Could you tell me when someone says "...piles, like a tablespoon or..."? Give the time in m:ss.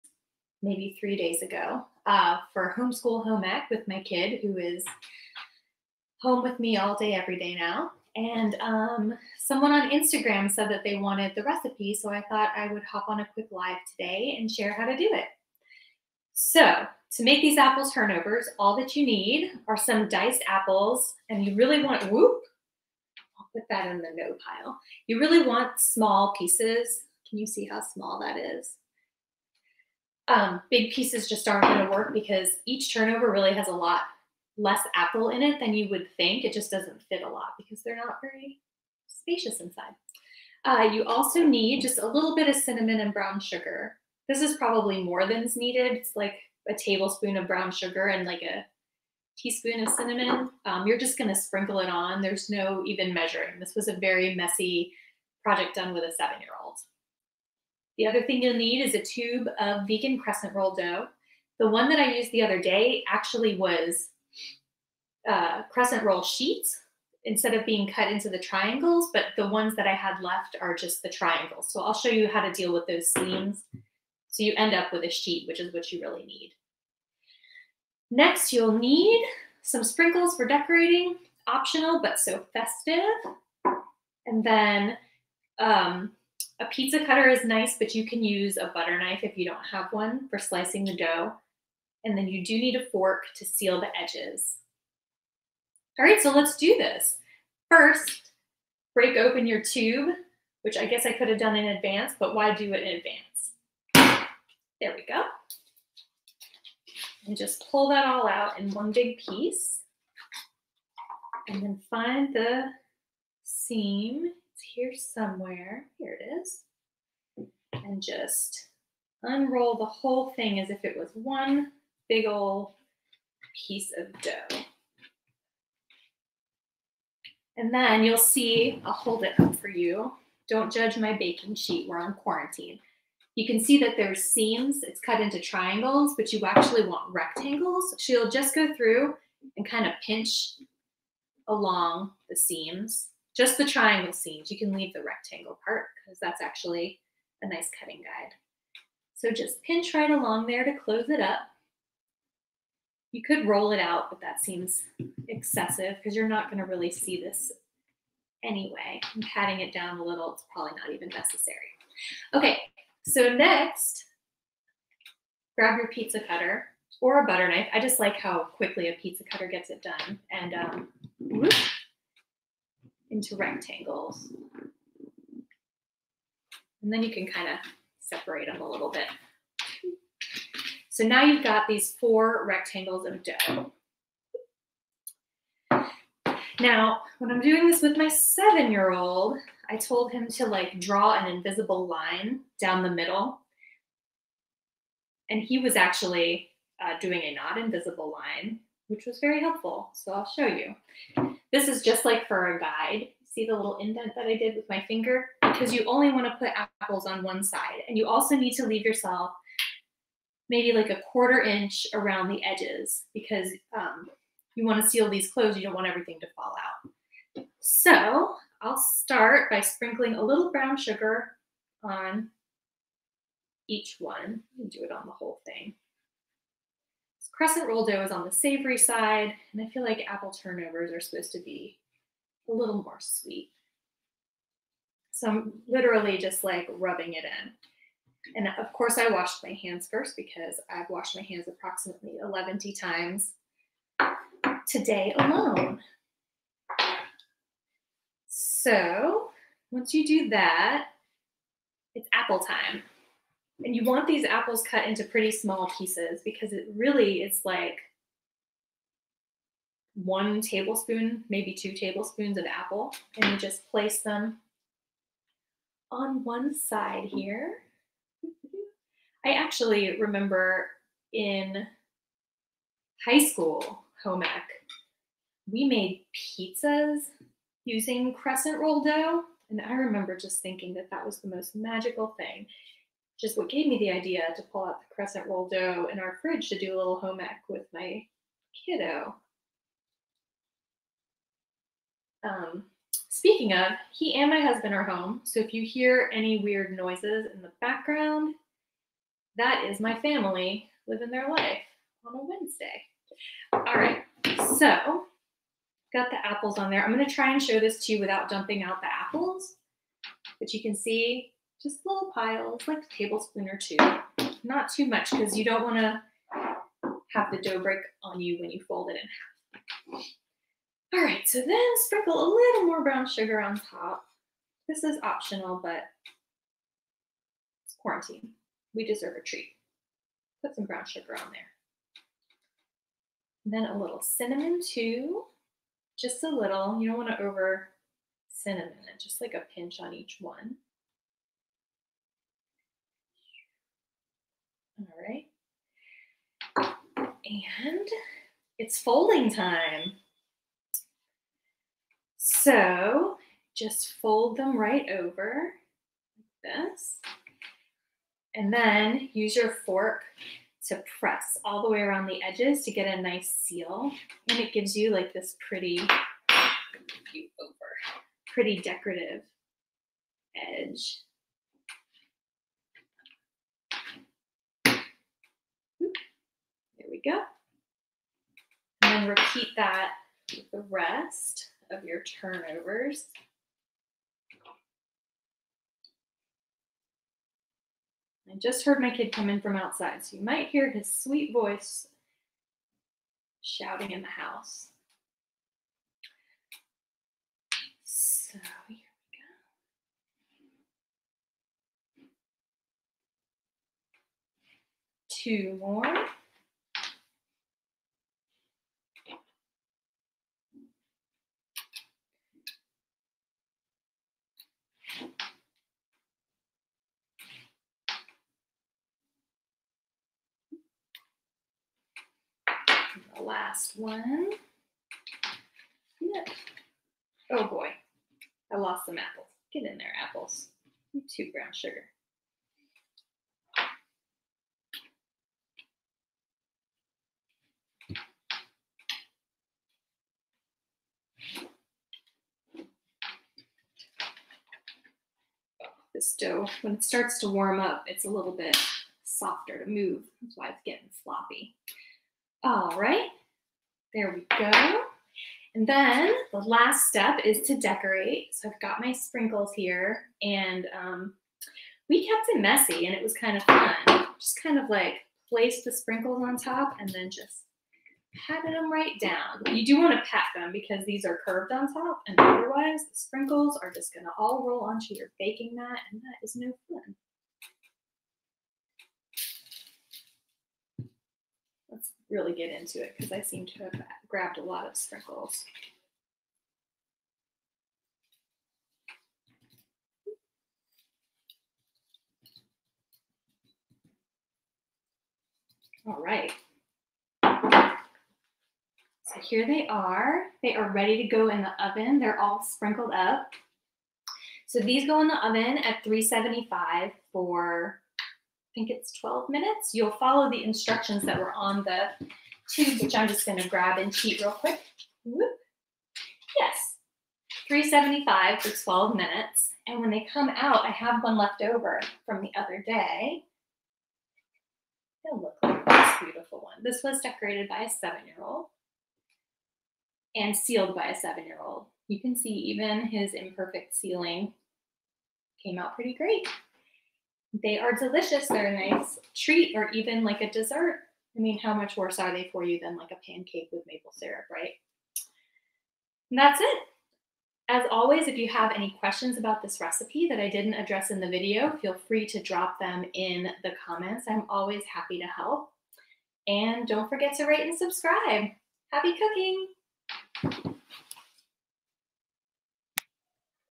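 5:12.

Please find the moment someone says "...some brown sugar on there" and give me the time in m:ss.
5:30.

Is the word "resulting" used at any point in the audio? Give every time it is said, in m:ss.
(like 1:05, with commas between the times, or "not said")
not said.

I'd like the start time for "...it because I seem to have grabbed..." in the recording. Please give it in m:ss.
8:02.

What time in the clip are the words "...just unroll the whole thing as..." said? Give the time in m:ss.
1:58.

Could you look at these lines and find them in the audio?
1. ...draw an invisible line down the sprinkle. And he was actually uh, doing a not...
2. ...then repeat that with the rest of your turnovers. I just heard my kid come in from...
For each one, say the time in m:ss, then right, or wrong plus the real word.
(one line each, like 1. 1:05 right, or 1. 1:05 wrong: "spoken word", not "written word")
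1. 3:10 wrong: "middle", not "sprinkle"
2. 6:19 right.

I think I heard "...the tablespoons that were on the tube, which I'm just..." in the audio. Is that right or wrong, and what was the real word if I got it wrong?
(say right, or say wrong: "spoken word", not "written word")
wrong: "instructions", not "tablespoons".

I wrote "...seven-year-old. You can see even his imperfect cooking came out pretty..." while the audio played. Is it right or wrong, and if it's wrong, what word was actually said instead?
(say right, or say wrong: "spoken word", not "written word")
wrong: "sealing", not "cooking".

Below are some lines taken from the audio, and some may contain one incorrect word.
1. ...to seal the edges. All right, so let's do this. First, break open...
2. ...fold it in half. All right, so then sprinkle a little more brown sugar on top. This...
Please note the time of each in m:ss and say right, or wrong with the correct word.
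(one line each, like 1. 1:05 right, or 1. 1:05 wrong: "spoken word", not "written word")
1. 1:33 right
2. 5:18 right.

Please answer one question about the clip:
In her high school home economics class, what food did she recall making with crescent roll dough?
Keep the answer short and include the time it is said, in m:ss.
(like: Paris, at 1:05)
pizzas, at 4:36.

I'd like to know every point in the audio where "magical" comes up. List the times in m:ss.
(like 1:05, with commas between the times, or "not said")
4:41.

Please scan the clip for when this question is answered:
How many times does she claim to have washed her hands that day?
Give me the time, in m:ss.
4:02.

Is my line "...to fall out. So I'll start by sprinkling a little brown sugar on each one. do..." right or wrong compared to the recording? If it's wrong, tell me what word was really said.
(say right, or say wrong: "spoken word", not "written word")
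right.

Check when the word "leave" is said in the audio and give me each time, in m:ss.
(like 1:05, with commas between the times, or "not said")
2:24, 3:28.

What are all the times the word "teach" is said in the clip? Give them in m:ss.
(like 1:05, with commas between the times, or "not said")
not said.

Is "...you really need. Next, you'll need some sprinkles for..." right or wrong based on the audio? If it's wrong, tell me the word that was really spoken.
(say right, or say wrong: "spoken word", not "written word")
right.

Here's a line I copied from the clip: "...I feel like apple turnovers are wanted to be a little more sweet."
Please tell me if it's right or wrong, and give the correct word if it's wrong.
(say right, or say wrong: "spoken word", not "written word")
wrong: "supposed", not "wanted".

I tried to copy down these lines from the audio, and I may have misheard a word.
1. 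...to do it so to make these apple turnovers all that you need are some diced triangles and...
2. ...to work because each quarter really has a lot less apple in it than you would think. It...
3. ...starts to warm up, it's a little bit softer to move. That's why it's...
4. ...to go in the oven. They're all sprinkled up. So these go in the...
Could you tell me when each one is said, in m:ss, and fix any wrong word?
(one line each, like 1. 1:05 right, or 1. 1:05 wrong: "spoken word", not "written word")
1. 0:14 wrong: "apples", not "triangles"
2. 0:31 wrong: "turnover", not "quarter"
3. 7:26 right
4. 8:20 right.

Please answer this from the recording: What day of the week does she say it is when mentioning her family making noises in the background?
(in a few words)
Wednesday.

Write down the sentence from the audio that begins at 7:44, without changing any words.
Just kind of like placed the sprinkles on top and then just patted them right down.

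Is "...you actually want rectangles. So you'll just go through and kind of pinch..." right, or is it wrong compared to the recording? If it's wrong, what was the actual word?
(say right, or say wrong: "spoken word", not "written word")
right.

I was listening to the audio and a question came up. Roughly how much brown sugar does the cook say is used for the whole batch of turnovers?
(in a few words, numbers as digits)
1 tablespoon.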